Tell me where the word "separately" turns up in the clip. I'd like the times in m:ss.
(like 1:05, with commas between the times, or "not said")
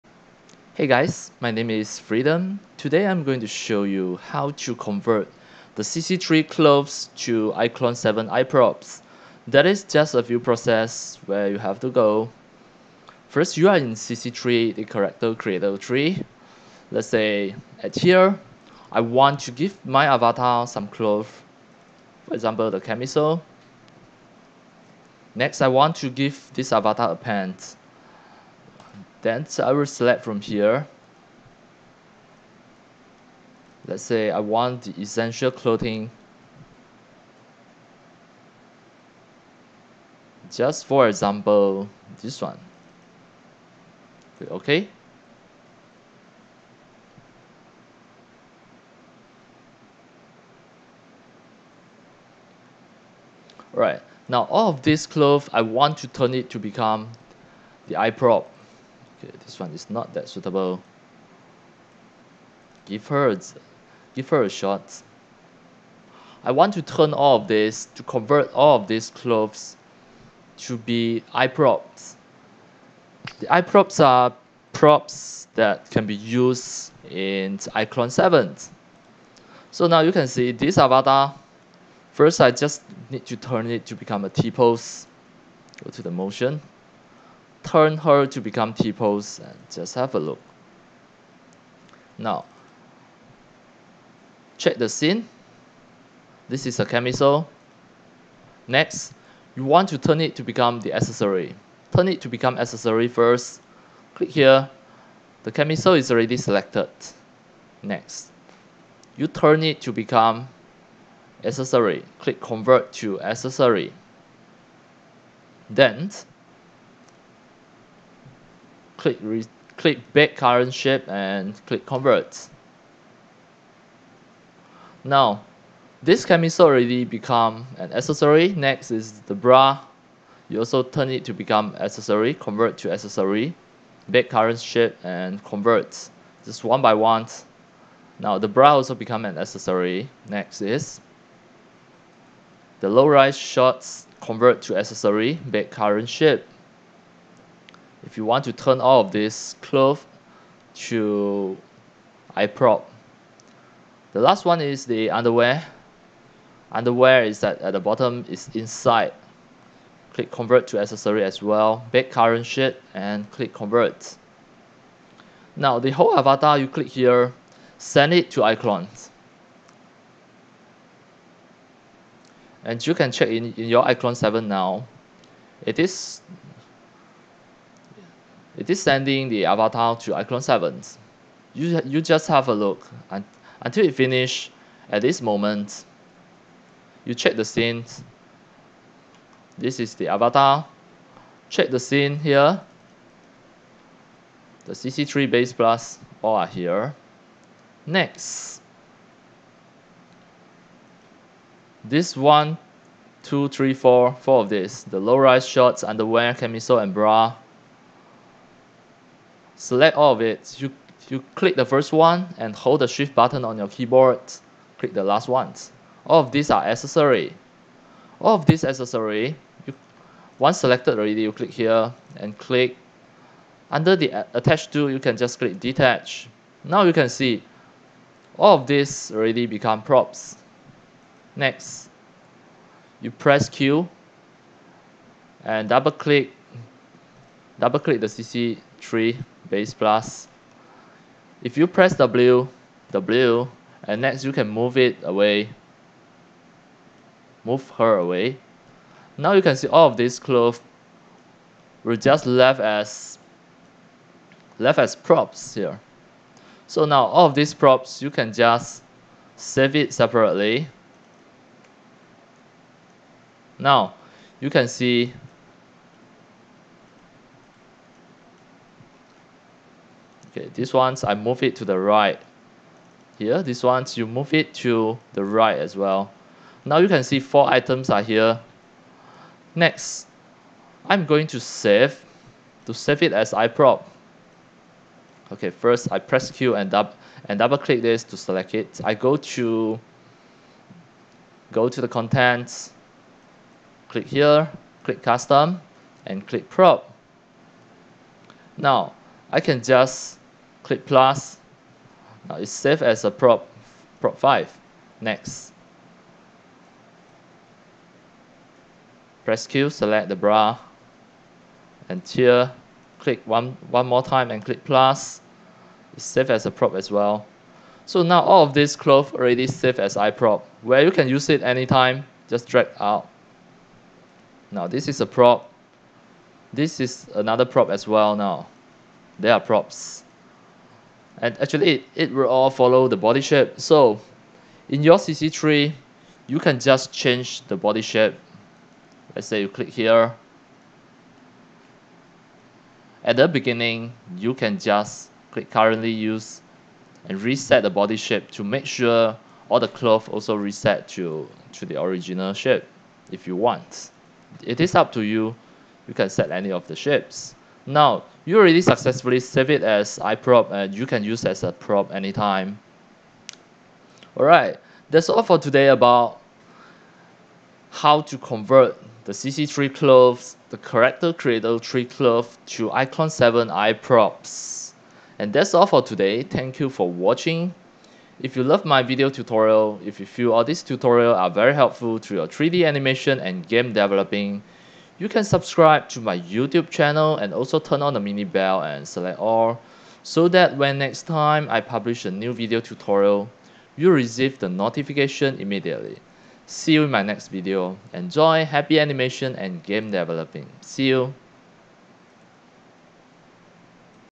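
4:19.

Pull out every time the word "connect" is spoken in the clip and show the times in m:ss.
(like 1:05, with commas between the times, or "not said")
not said.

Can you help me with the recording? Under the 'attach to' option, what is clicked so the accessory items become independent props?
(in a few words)
Detach.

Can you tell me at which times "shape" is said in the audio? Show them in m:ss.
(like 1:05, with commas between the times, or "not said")
2:00, 2:14, 2:26, 5:33, 5:37, 5:47, 5:52, 5:56.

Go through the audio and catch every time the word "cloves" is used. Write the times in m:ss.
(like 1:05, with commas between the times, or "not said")
6:09.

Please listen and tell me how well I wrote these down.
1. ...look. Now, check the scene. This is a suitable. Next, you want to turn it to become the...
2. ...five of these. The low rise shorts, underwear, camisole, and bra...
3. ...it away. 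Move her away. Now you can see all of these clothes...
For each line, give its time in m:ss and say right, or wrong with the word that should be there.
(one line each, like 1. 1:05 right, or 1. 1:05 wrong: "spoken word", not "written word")
1. 1:30 wrong: "camisole", not "suitable"
2. 3:24 wrong: "four", not "five"
3. 4:04 right.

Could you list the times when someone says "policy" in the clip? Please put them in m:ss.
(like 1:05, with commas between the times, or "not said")
not said.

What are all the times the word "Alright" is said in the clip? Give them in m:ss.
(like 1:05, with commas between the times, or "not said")
0:53, 6:04.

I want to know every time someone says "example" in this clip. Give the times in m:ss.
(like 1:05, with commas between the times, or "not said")
0:22, 0:41.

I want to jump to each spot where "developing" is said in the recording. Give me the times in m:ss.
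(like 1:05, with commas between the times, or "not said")
6:23, 6:39.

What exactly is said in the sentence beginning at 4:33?
Here, this one's you move it to the right as well.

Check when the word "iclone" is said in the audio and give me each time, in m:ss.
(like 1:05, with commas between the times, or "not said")
0:07, 1:17, 2:48, 2:53, 3:00, 6:12.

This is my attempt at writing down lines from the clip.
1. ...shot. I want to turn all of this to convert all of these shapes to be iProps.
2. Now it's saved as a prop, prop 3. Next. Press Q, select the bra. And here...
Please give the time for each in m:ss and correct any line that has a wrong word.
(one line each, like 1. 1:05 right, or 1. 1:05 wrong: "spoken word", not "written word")
1. 1:04 wrong: "clothes", not "shapes"
2. 5:02 wrong: "5", not "3".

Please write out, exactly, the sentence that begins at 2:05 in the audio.
Now, this camisole already become an accessory.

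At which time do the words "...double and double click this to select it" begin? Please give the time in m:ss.
4:46.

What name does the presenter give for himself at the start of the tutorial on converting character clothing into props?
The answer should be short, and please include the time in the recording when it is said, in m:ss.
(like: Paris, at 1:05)
Freedom, at 0:01.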